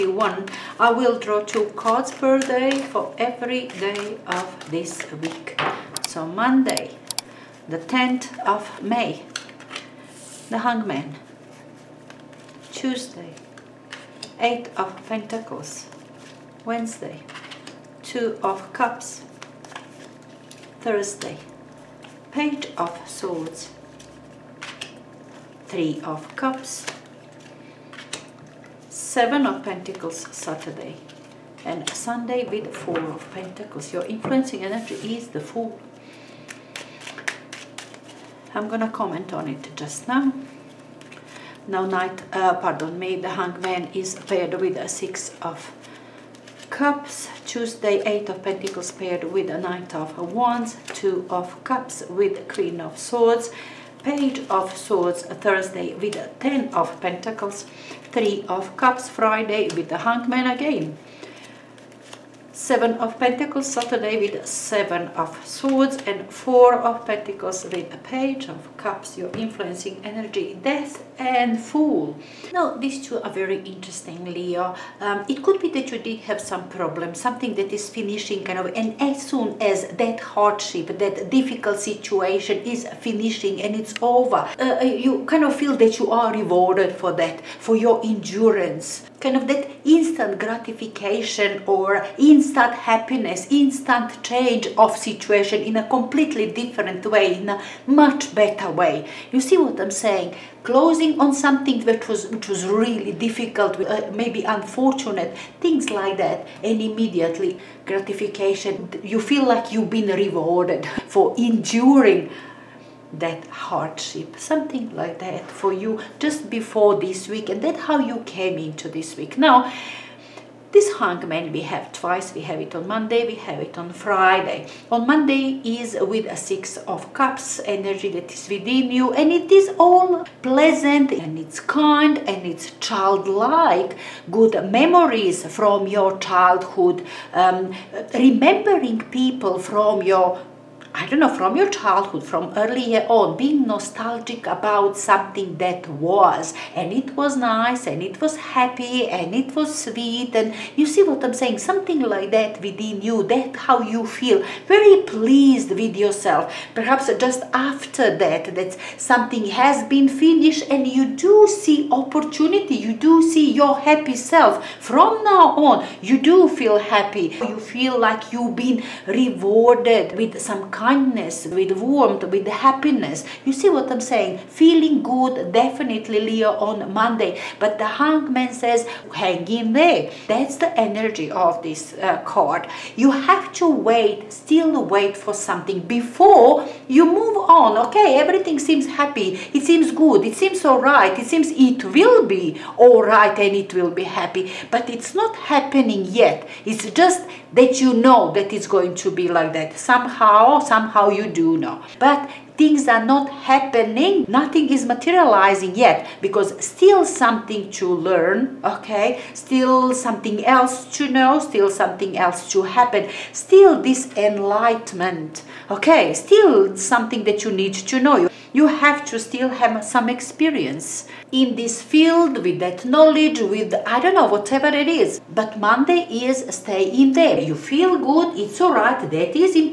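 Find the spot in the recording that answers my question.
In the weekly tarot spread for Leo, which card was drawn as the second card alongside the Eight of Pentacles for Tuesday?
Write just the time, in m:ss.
0:49.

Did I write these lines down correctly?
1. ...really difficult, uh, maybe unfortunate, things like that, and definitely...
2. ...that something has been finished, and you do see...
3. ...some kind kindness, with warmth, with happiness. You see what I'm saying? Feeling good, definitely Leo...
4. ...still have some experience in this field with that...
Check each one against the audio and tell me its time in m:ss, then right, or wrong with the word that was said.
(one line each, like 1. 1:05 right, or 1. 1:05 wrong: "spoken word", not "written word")
1. 1:42 wrong: "immediately", not "definitely"
2. 2:38 right
3. 2:50 right
4. 3:39 right.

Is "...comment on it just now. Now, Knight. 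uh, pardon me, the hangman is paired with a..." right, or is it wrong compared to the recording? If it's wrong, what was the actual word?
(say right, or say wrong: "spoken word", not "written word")
right.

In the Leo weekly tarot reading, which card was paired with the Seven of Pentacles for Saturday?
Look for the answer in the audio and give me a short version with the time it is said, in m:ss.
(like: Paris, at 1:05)
Seven of Swords, at 1:04.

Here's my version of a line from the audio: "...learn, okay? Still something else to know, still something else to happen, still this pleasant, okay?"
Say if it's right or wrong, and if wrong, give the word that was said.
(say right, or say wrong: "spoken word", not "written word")
wrong: "enlightenment", not "pleasant".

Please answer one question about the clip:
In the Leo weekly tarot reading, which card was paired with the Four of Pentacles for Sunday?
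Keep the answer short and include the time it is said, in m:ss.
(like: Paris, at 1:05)
Page of Cups, at 1:07.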